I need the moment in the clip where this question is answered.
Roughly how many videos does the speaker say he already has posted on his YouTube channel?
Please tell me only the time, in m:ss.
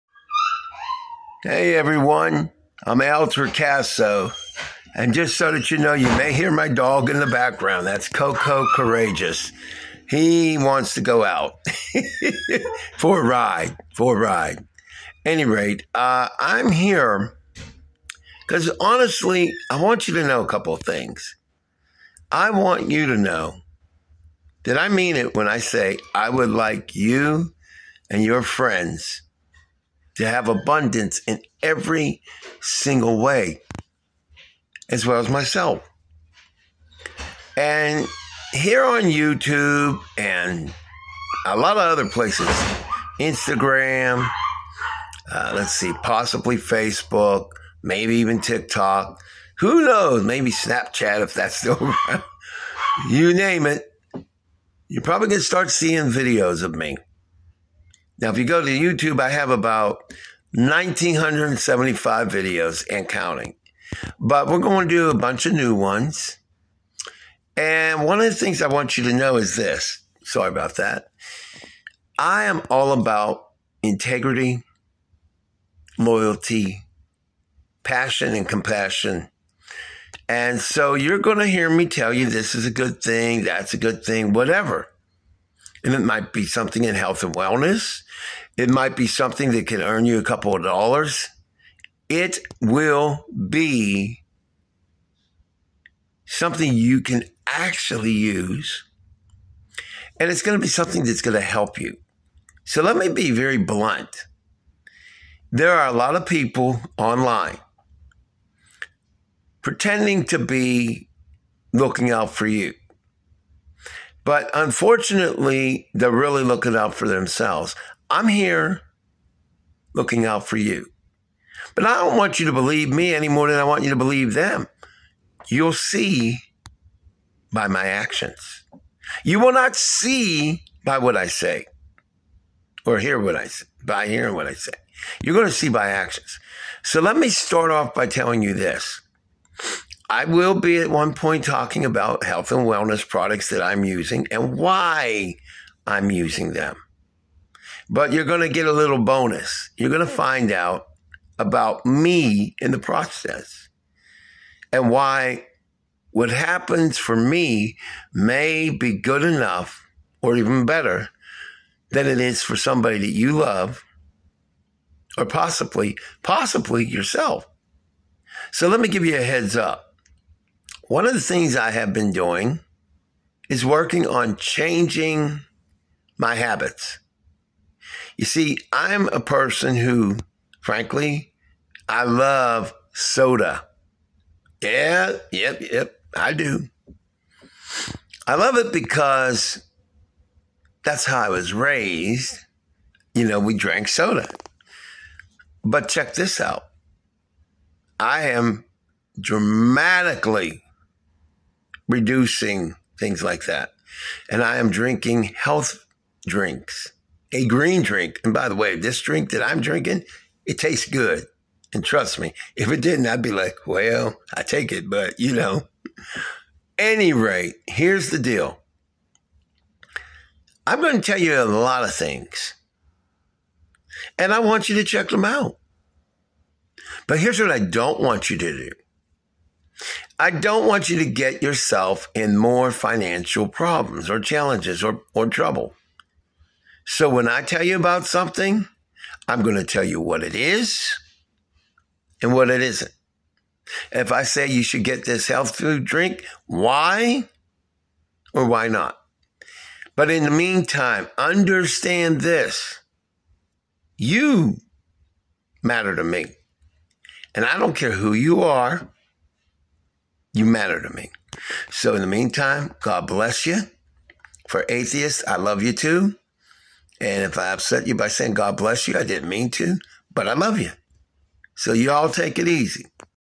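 1:00.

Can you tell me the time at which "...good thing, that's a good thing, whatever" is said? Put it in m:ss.
1:22.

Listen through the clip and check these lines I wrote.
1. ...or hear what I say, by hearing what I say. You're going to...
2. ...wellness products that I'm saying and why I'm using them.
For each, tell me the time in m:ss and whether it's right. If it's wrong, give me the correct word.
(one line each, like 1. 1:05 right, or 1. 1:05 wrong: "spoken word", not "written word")
1. 2:12 right
2. 2:22 wrong: "using", not "saying".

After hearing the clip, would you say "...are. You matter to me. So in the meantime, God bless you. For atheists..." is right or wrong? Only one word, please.
right.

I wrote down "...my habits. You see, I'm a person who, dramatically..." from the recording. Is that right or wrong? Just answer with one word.
wrong.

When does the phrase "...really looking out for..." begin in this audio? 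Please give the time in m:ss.
1:56.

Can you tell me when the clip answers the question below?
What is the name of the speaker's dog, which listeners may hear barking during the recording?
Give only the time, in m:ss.
0:08.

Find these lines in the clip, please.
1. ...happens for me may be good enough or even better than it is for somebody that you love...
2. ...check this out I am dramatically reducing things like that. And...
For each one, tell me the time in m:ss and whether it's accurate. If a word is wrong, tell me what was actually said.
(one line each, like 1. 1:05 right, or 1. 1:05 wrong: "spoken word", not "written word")
1. 2:36 right
2. 3:15 right.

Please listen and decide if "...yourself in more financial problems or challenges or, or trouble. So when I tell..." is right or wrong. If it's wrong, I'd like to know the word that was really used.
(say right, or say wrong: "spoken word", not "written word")
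right.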